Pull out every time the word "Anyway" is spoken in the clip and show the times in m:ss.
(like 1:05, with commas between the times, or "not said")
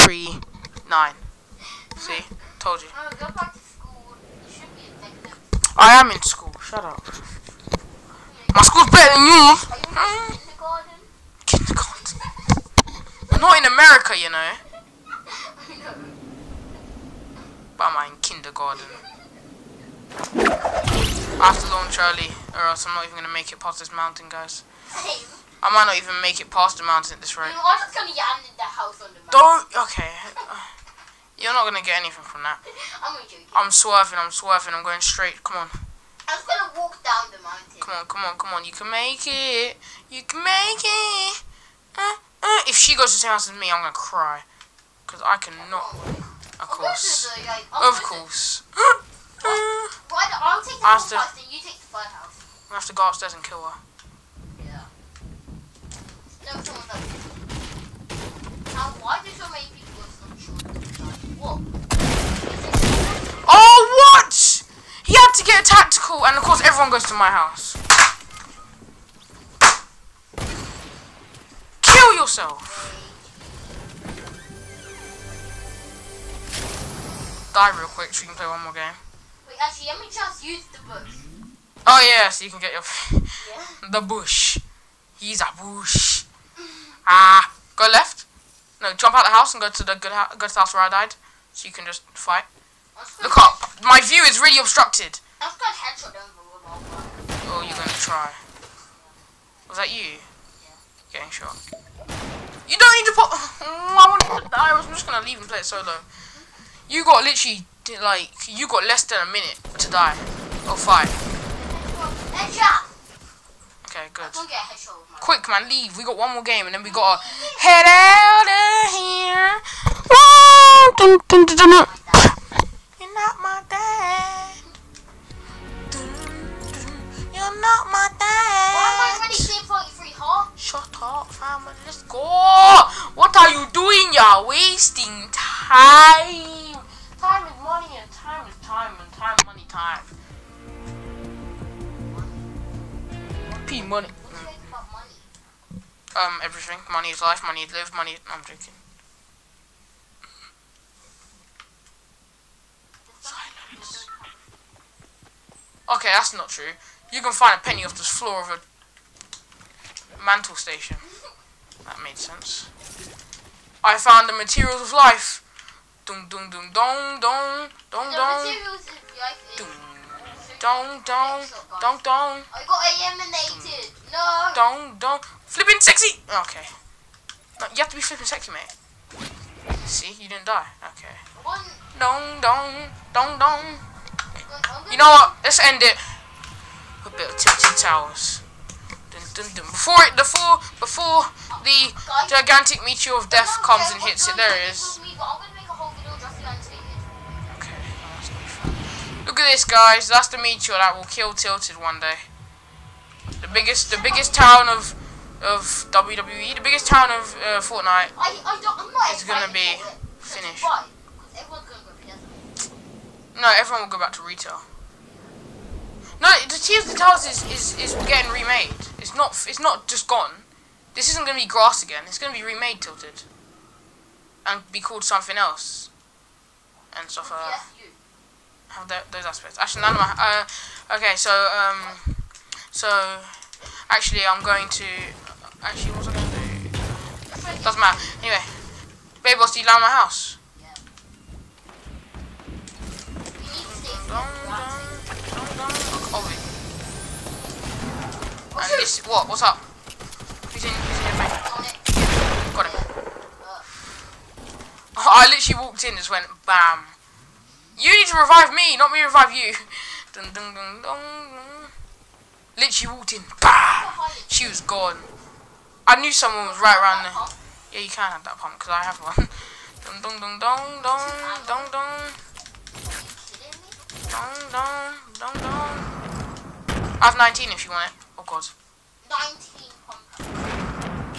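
3:58.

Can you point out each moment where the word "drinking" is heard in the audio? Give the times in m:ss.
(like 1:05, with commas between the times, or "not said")
2:28.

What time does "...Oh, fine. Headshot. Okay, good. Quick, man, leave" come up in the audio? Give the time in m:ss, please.
1:50.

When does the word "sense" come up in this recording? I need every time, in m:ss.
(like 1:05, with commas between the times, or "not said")
2:42.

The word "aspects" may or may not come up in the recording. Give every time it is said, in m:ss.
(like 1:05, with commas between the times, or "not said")
3:49.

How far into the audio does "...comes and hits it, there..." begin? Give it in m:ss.
3:13.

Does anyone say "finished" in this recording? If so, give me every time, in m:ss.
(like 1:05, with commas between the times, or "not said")
3:30.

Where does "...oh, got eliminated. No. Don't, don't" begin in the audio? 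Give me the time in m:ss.
2:52.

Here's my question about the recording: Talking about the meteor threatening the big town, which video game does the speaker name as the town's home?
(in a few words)
Fortnite.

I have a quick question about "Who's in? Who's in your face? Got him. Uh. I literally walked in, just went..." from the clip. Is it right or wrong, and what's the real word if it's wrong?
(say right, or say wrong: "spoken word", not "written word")
right.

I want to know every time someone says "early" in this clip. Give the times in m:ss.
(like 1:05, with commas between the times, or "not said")
0:21.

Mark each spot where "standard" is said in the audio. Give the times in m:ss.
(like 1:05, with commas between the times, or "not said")
not said.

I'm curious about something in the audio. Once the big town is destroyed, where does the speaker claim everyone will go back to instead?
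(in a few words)
Retail.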